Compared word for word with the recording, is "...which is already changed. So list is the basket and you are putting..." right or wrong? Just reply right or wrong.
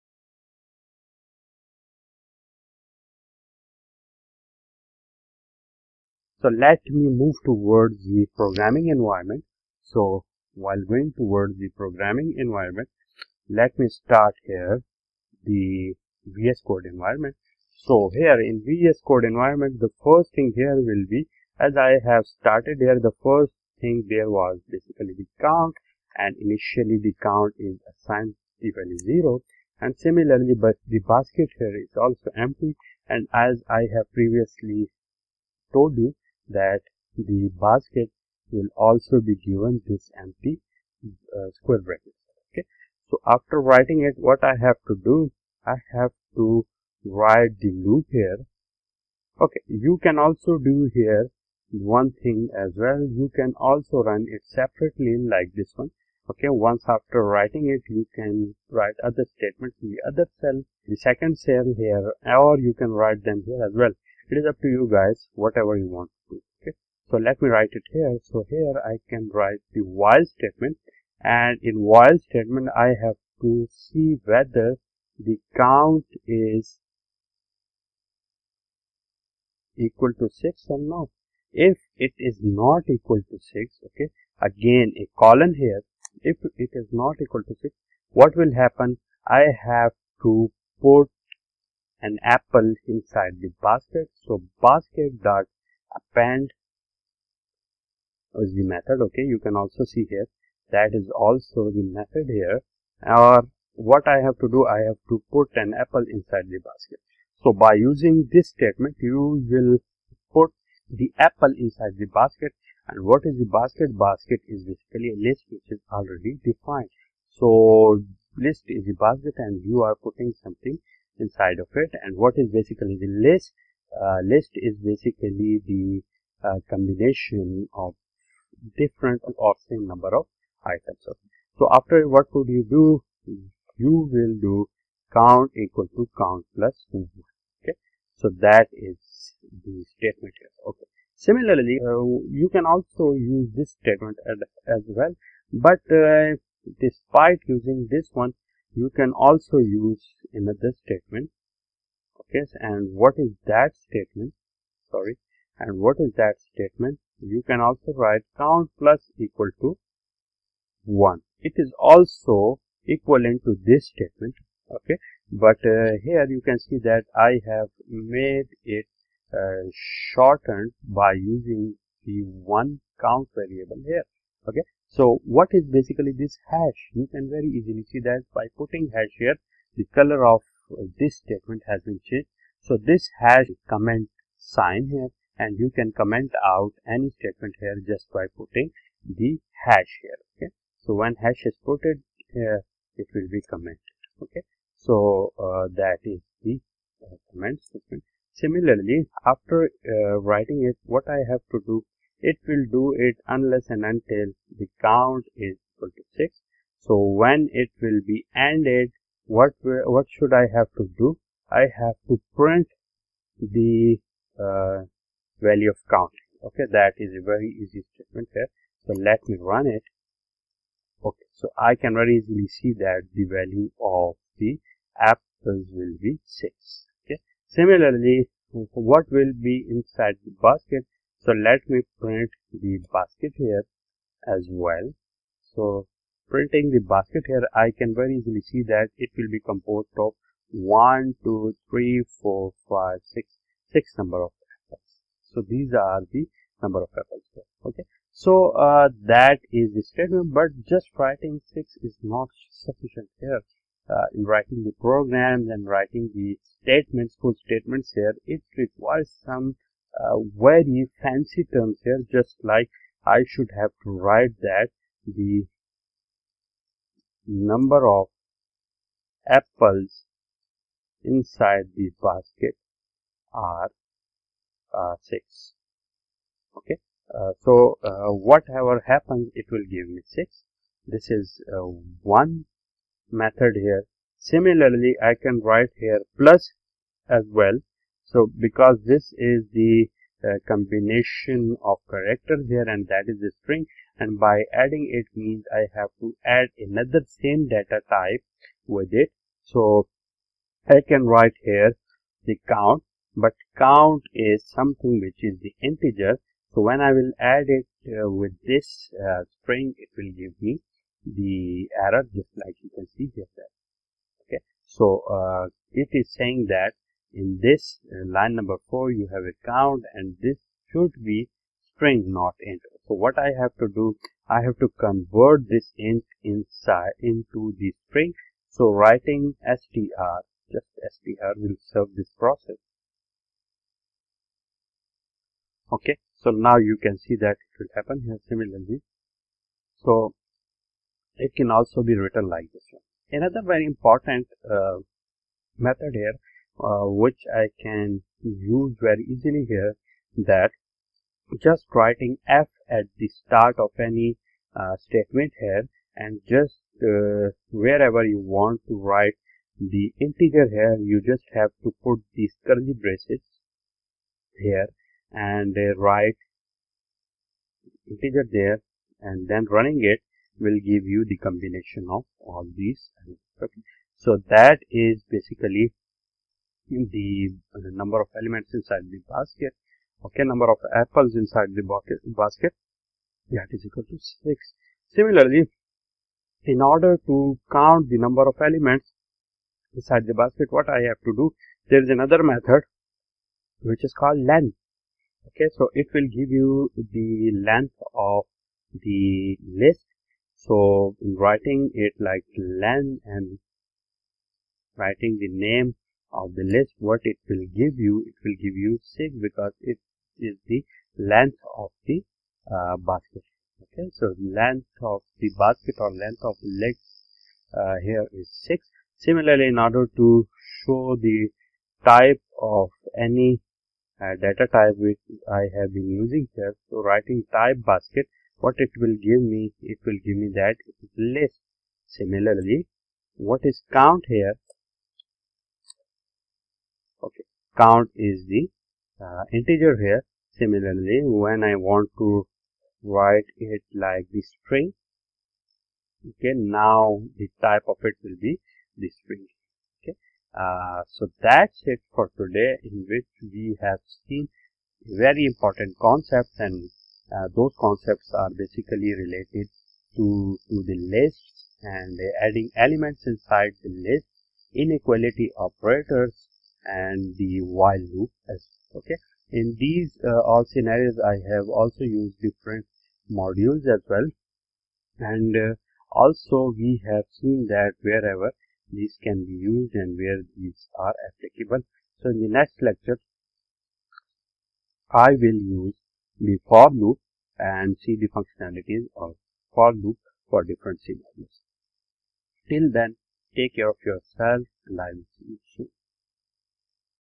wrong.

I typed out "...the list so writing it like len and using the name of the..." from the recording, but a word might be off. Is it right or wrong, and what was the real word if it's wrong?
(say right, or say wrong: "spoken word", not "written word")
wrong: "writing", not "using".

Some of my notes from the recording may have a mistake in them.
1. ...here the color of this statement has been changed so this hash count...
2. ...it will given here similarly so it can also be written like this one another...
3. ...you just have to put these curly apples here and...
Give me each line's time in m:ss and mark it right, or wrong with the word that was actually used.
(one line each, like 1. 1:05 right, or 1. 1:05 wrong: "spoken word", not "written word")
1. 2:59 wrong: "comment", not "count"
2. 5:37 wrong: "happen", not "given"
3. 6:00 wrong: "braces", not "apples".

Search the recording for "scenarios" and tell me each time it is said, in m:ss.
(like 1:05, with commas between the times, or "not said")
7:50, 8:10.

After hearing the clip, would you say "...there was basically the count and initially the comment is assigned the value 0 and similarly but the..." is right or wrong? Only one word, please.
wrong.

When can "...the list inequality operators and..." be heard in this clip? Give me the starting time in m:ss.
7:43.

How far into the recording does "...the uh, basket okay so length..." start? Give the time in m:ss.
6:51.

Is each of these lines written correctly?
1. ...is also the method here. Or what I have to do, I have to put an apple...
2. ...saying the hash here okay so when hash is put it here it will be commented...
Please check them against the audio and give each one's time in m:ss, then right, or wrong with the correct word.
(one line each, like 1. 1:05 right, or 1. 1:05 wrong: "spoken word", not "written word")
1. 1:40 right
2. 3:08 wrong: "putting", not "saying".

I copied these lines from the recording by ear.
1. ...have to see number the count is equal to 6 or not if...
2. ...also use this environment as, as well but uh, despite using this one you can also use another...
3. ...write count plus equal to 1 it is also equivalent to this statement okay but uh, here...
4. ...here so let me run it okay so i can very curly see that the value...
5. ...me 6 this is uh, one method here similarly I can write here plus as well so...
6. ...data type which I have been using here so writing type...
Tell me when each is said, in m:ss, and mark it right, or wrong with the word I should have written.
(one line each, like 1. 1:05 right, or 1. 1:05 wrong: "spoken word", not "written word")
1. 1:13 wrong: "whether", not "number"
2. 2:22 wrong: "statement", not "environment"
3. 2:37 right
4. 3:38 wrong: "easily", not "curly"
5. 4:39 right
6. 7:04 right.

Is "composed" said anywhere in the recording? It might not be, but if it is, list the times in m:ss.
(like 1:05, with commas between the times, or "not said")
3:59.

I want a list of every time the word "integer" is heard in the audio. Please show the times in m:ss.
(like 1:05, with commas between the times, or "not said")
5:05, 5:59, 6:07, 7:19.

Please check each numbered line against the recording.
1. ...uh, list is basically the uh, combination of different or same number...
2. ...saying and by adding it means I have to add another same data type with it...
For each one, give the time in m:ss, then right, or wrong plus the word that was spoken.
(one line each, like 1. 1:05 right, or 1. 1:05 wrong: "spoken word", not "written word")
1. 2:04 right
2. 4:53 wrong: "string", not "saying".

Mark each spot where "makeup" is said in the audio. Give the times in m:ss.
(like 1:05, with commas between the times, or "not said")
not said.